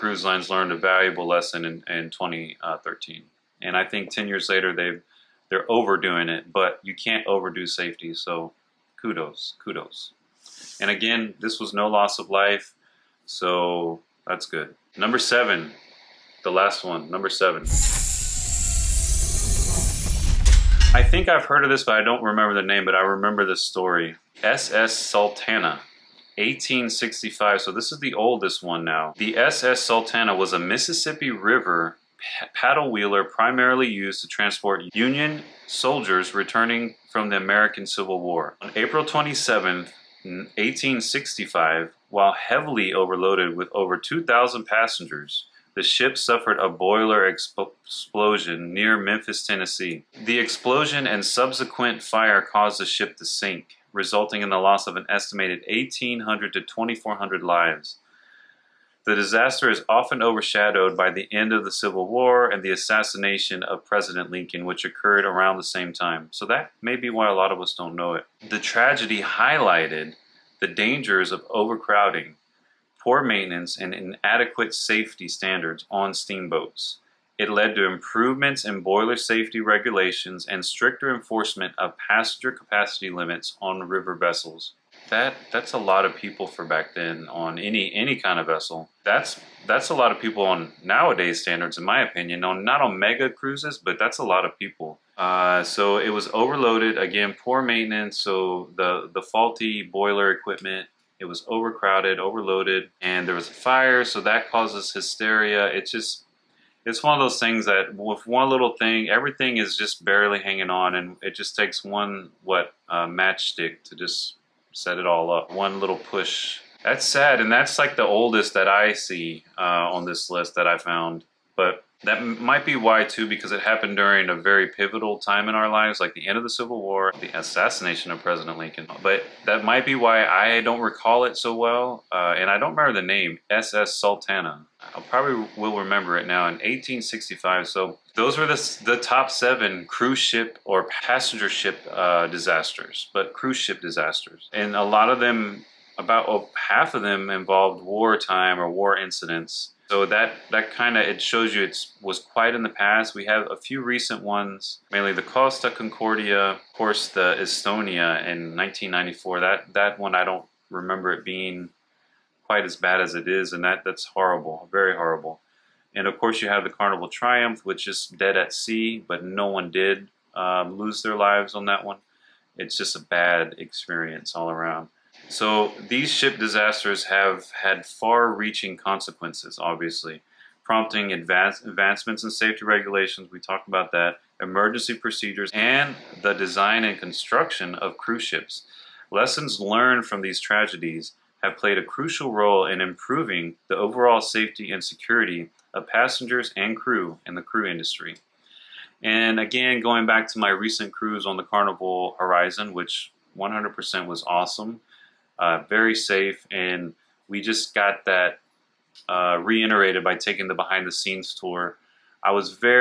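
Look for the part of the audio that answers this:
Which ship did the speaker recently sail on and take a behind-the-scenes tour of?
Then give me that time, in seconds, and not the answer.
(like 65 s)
201 s.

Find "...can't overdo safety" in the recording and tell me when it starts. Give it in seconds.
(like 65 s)
6 s.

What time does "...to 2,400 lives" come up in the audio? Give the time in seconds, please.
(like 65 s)
56 s.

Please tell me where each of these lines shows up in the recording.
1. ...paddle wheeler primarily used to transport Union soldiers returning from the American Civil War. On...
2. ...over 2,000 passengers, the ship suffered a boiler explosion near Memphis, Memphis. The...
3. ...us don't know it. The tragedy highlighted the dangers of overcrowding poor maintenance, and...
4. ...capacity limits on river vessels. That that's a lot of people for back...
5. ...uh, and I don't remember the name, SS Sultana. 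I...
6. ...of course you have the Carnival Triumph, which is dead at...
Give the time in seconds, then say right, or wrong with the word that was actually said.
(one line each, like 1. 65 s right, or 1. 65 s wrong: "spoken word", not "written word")
1. 32 s right
2. 43 s wrong: "Tennessee", not "Memphis"
3. 67 s right
4. 82 s right
5. 132 s right
6. 166 s right.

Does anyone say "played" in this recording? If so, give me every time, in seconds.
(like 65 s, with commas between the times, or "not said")
191 s.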